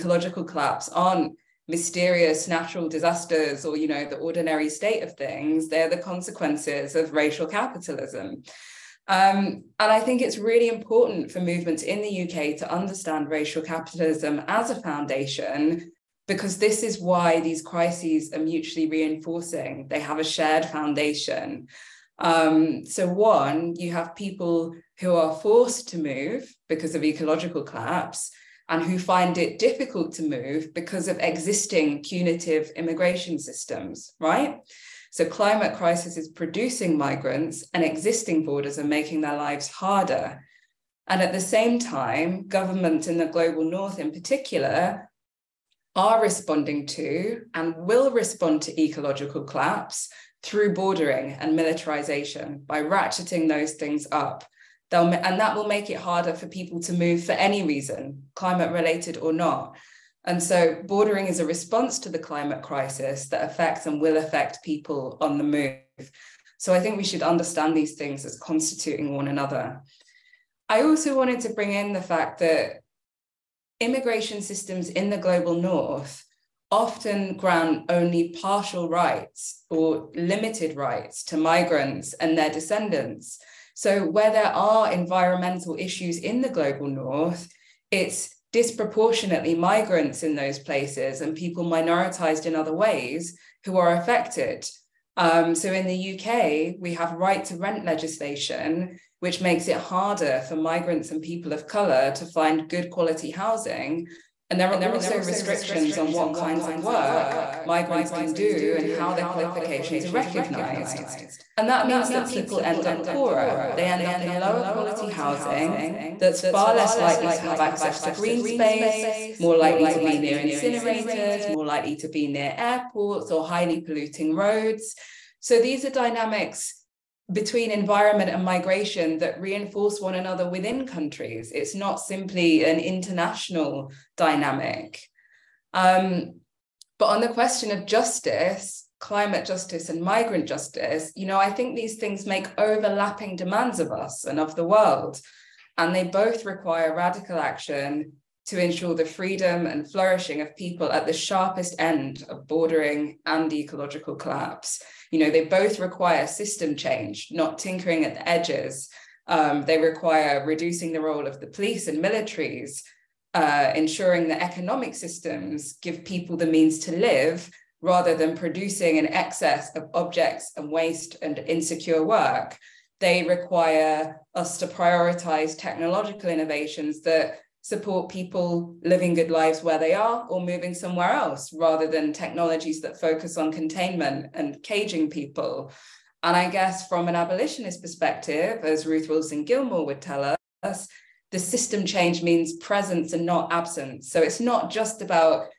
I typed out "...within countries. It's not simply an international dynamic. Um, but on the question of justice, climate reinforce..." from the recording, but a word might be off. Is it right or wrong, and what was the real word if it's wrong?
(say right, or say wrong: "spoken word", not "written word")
wrong: "justice", not "reinforce".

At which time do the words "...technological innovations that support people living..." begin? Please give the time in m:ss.
2:55.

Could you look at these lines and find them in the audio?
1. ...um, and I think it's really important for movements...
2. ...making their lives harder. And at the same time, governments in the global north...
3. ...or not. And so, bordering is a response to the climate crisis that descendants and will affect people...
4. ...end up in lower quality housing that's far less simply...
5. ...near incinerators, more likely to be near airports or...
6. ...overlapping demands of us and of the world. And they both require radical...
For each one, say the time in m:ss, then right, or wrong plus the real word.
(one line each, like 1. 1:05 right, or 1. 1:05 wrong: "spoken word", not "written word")
1. 0:09 right
2. 0:38 right
3. 0:59 wrong: "affects", not "descendants"
4. 1:53 wrong: "likely", not "simply"
5. 2:00 right
6. 2:22 right.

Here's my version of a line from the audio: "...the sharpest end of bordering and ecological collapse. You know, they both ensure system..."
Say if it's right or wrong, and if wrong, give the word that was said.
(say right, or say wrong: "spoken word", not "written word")
wrong: "require", not "ensure".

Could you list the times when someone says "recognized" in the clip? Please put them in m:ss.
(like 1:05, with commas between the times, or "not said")
1:50.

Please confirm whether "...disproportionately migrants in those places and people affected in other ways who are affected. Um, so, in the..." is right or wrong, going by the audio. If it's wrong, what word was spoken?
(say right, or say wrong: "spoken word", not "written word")
wrong: "minoritized", not "affected".